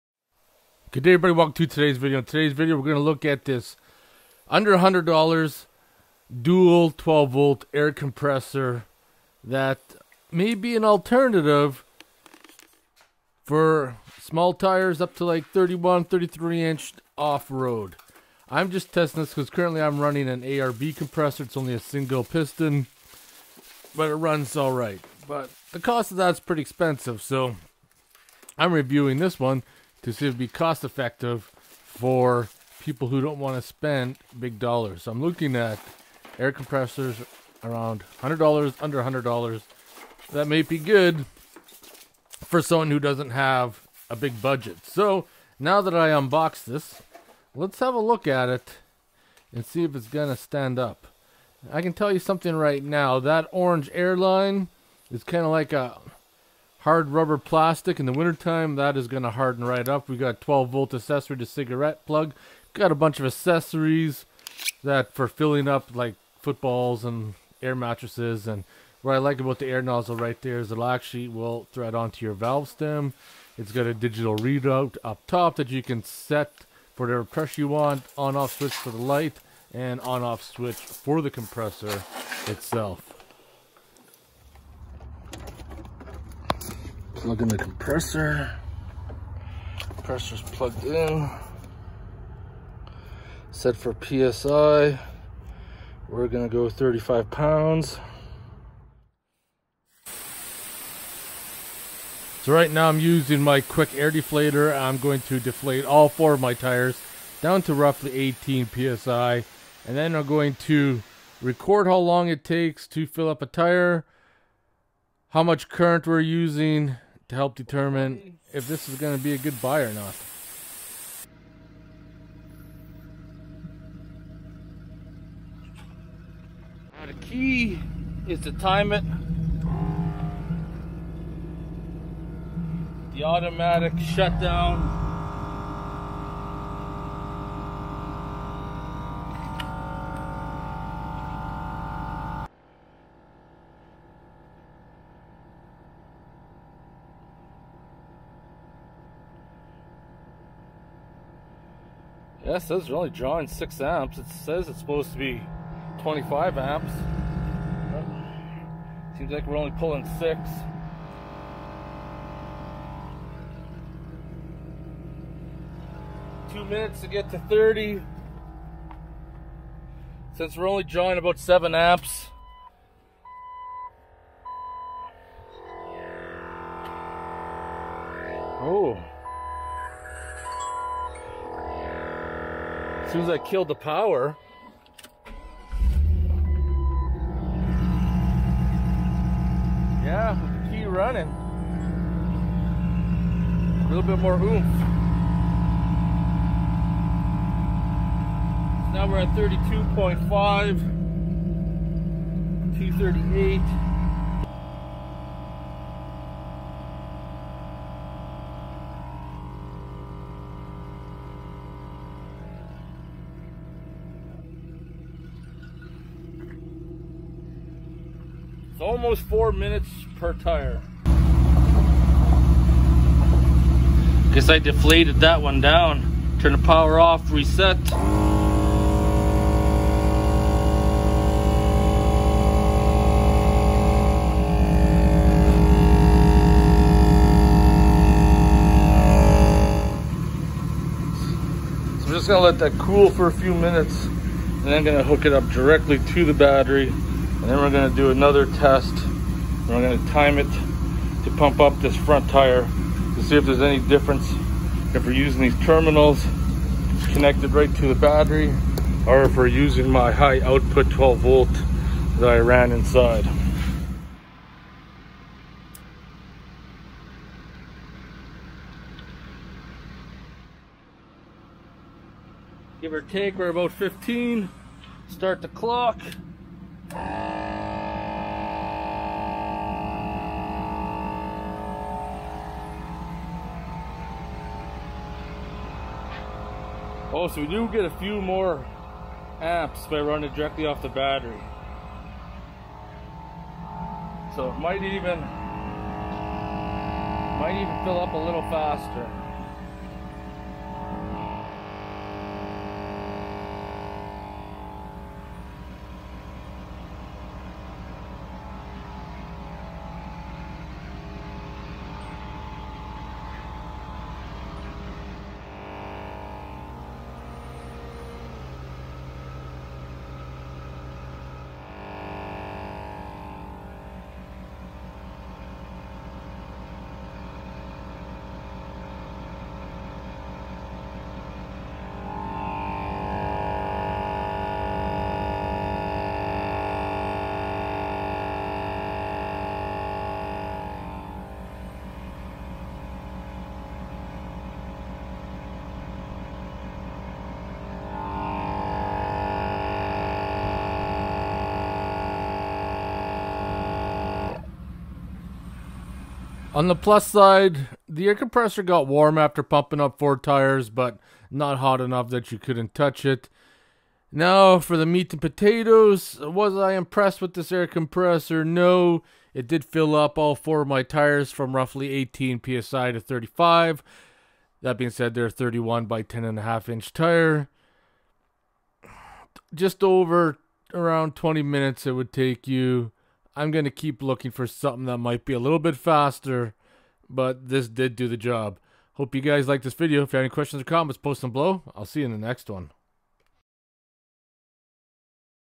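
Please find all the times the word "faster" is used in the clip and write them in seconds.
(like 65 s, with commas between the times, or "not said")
298 s, 385 s.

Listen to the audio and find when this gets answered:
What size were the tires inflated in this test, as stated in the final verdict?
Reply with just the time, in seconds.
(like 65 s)
375 s.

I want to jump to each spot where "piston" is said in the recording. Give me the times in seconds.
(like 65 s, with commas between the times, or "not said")
22 s.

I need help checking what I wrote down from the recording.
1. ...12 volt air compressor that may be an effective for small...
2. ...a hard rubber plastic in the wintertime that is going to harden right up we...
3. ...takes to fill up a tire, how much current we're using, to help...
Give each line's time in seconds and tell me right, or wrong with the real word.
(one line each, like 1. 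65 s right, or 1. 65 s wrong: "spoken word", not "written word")
1. 6 s wrong: "alternative", not "effective"
2. 55 s right
3. 112 s right.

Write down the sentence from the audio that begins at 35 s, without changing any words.
So I'm looking at air compressors around $100, under $100.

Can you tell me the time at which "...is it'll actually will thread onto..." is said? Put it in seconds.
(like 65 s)
70 s.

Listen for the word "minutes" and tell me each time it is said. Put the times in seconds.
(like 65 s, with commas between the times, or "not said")
166 s, 219 s, 243 s, 381 s.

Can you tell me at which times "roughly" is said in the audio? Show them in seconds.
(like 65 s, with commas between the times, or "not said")
107 s, 371 s.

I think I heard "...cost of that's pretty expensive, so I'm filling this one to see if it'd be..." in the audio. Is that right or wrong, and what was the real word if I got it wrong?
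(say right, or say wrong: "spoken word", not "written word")
wrong: "reviewing", not "filling".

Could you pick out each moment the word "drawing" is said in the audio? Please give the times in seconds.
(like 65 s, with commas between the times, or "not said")
153 s, 170 s.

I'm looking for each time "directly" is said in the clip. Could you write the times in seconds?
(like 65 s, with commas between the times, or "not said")
245 s, 290 s.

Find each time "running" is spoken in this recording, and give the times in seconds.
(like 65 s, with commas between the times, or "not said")
20 s, 190 s, 289 s.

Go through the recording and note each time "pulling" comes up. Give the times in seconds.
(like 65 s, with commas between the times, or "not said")
159 s.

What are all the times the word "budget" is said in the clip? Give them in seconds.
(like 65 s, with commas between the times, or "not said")
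44 s.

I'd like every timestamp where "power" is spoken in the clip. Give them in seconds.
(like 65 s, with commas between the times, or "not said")
183 s, 226 s.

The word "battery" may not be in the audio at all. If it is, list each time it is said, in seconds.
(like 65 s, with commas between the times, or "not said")
246 s, 257 s, 290 s.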